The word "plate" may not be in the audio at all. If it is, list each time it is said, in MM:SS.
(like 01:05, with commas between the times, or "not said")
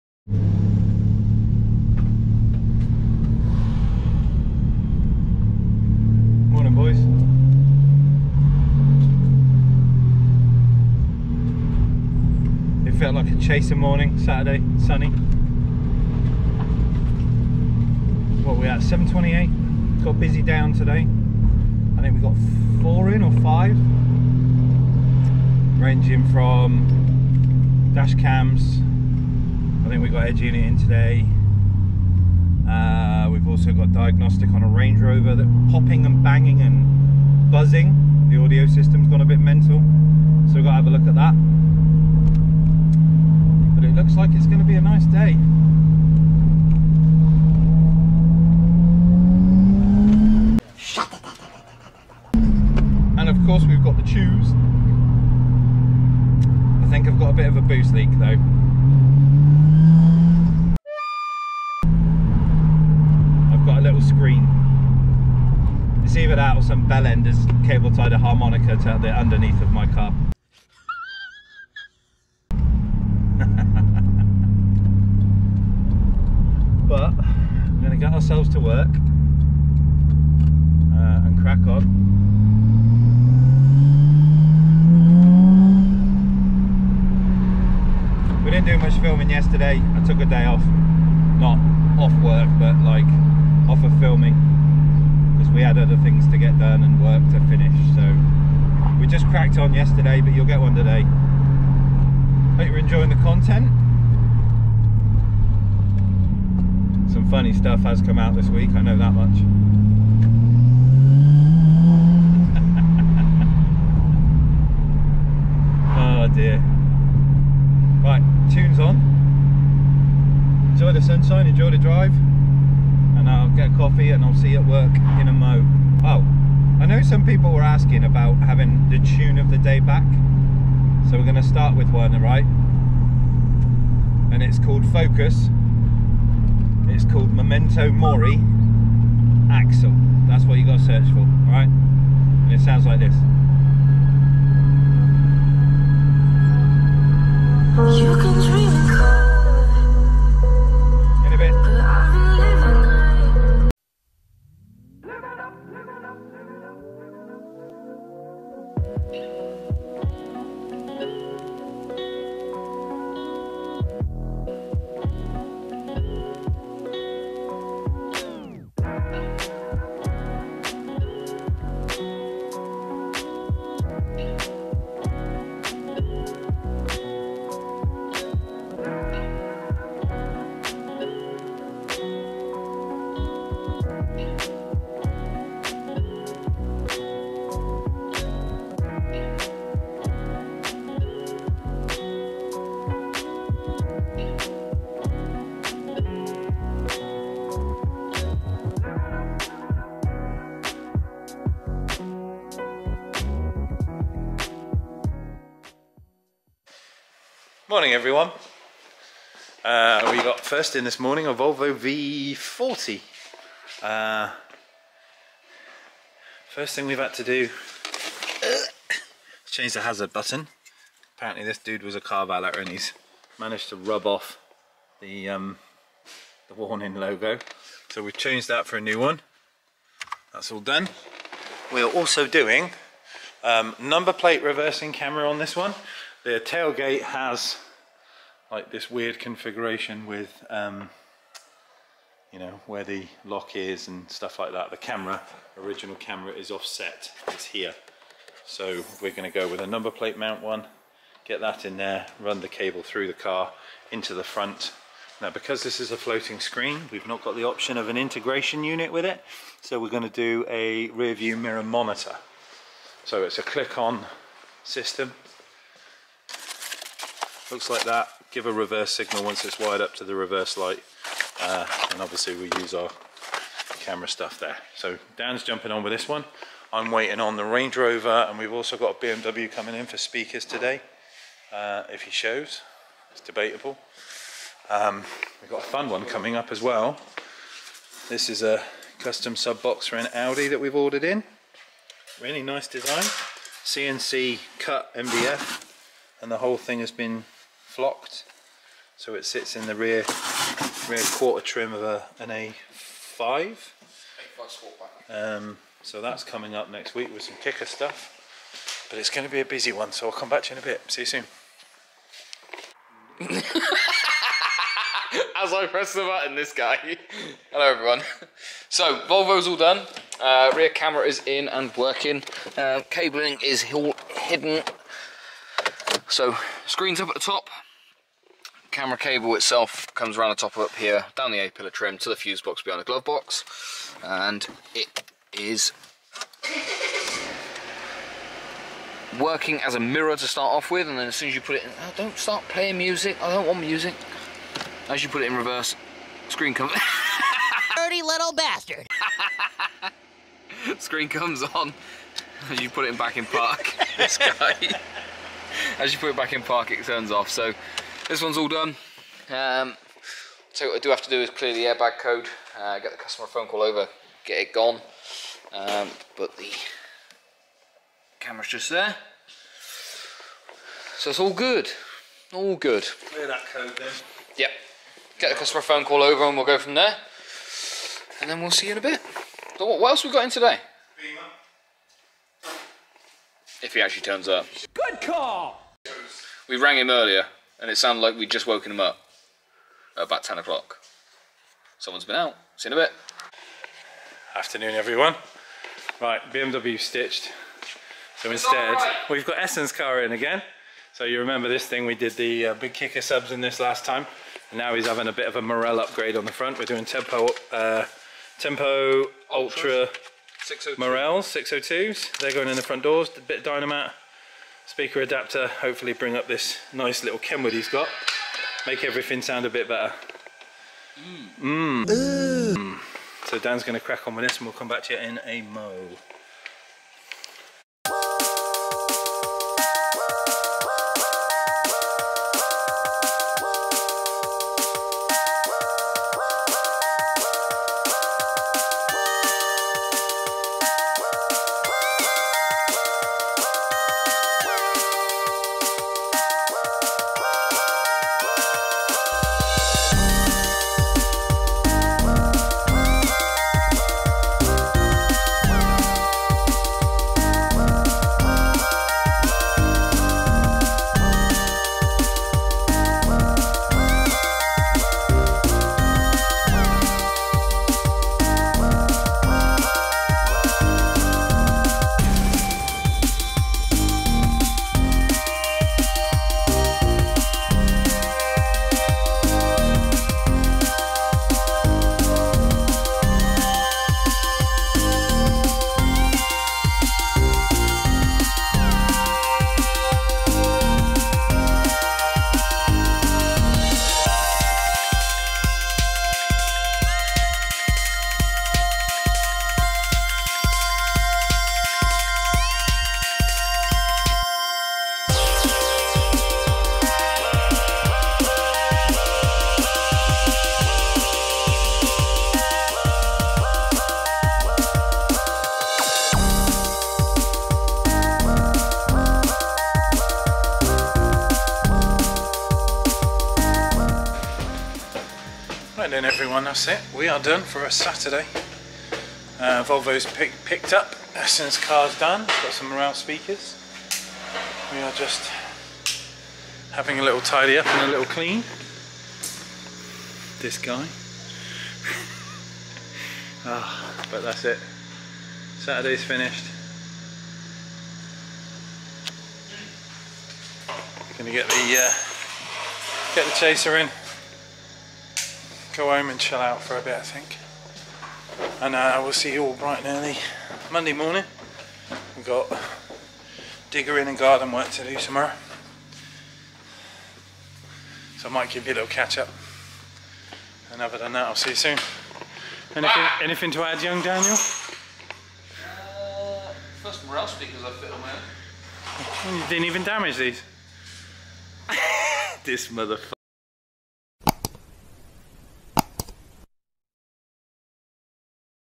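03:54, 04:09.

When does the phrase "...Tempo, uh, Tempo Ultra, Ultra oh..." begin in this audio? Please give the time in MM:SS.
06:46.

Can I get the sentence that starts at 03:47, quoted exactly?
So we've changed that for a new one.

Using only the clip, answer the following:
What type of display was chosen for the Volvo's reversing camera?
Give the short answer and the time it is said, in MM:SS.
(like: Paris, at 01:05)
rear view mirror monitor, at 04:20.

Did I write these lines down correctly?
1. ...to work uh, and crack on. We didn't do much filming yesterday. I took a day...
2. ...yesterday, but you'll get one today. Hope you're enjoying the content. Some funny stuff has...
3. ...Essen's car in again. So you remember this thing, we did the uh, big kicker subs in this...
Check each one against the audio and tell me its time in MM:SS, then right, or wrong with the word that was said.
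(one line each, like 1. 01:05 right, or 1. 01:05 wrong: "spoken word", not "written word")
1. 01:18 right
2. 01:39 right
3. 06:39 right.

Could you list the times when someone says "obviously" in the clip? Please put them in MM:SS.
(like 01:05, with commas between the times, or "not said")
04:32.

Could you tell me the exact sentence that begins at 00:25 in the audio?
Ranging from dash cams, we've got edge unit in today.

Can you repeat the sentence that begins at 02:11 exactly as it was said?
So we're going to start with one, right?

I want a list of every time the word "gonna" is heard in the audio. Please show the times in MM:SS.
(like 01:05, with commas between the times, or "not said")
04:09, 04:19, 09:11.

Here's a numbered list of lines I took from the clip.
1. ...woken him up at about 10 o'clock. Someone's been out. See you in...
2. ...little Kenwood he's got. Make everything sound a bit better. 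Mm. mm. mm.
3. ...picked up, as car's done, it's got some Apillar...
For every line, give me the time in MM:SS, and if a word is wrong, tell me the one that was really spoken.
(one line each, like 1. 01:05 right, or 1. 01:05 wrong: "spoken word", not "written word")
1. 06:28 right
2. 06:57 right
3. 08:50 wrong: "Morel", not "Apillar".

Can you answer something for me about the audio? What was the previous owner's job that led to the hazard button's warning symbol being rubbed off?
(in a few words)
car valet.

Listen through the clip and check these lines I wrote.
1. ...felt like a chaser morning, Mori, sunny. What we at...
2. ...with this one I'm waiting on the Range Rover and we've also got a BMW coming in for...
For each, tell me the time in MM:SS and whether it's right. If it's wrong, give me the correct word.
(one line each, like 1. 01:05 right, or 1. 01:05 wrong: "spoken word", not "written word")
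1. 00:12 wrong: "Saturday", not "Mori"
2. 04:35 right.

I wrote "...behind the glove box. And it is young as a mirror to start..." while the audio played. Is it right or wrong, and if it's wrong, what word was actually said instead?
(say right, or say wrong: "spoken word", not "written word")
wrong: "working", not "young".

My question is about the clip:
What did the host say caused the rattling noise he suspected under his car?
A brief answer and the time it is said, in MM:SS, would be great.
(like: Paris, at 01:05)
boost leak, at 00:57.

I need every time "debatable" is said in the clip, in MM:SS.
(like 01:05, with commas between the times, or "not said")
04:43.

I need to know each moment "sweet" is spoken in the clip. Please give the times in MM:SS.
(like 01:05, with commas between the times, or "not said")
not said.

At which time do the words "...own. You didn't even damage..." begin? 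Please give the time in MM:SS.
09:39.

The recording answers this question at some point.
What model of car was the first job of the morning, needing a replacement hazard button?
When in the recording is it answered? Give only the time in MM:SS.
03:31.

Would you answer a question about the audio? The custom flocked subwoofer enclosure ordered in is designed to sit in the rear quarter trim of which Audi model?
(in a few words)
A5.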